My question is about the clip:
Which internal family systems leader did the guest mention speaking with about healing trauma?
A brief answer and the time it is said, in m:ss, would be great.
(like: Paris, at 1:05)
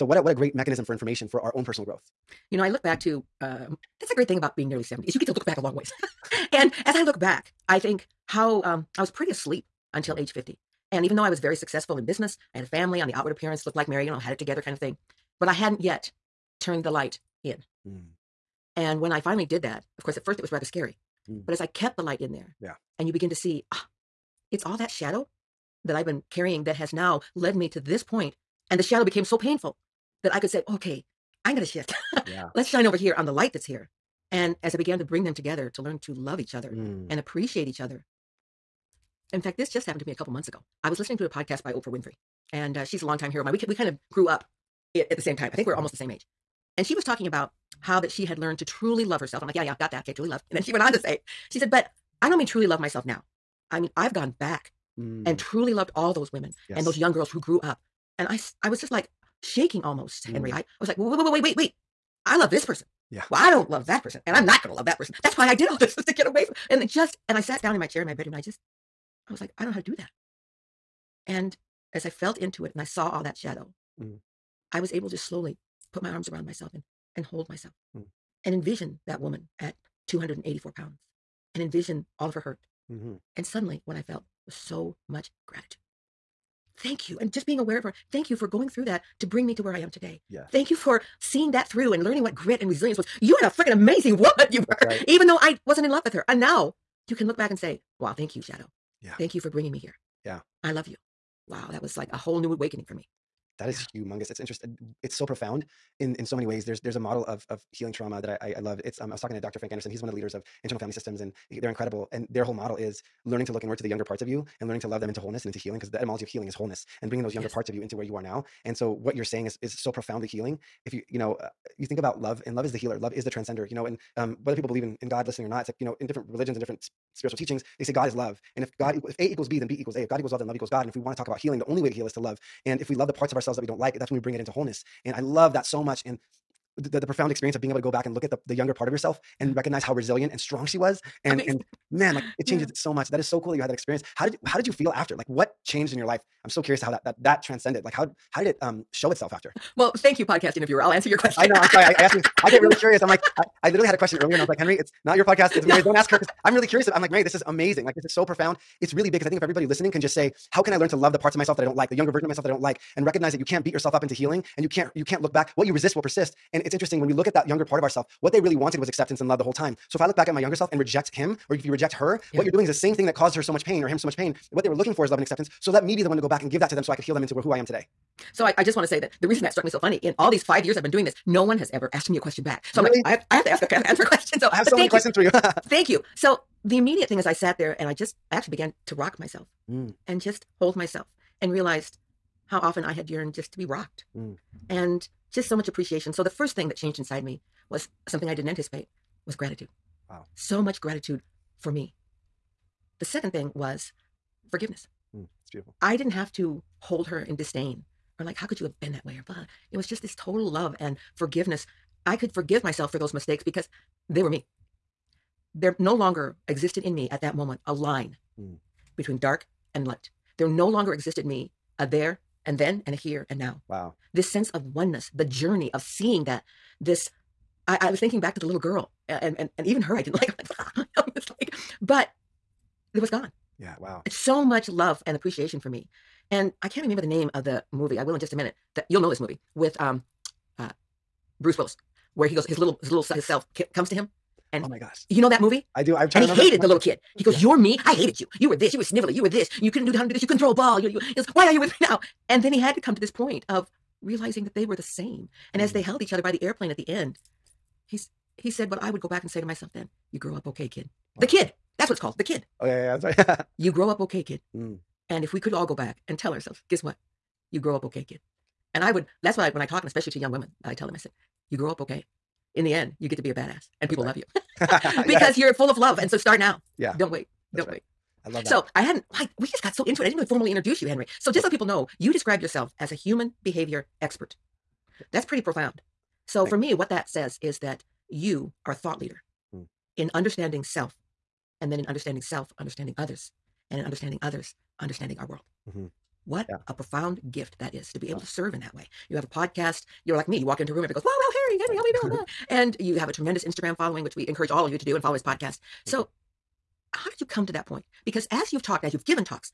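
Dr. Frank Anderson, at 1:49.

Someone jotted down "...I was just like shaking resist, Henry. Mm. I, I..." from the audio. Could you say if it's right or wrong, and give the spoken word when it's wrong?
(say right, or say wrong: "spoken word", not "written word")
wrong: "almost", not "resist".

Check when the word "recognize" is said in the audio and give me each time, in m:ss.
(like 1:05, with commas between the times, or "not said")
2:19, 2:43.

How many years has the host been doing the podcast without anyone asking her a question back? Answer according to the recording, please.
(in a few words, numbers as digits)
5.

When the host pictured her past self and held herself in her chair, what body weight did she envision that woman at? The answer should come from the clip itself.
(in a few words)
284 pounds.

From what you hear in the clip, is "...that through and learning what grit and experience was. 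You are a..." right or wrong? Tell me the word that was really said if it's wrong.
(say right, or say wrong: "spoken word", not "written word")
wrong: "resilience", not "experience".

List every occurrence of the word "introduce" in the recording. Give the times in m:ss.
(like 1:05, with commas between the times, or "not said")
4:40.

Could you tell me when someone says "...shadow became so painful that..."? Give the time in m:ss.
0:28.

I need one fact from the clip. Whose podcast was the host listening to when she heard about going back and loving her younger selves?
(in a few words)
Oprah Winfrey.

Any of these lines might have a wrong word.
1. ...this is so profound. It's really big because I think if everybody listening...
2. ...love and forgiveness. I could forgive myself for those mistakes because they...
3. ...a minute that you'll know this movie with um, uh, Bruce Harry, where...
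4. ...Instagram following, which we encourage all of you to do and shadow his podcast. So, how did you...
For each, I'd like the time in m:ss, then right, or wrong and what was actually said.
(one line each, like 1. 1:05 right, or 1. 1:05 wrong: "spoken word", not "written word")
1. 2:37 right
2. 3:30 right
3. 3:58 wrong: "Willis", not "Harry"
4. 5:03 wrong: "follow", not "shadow".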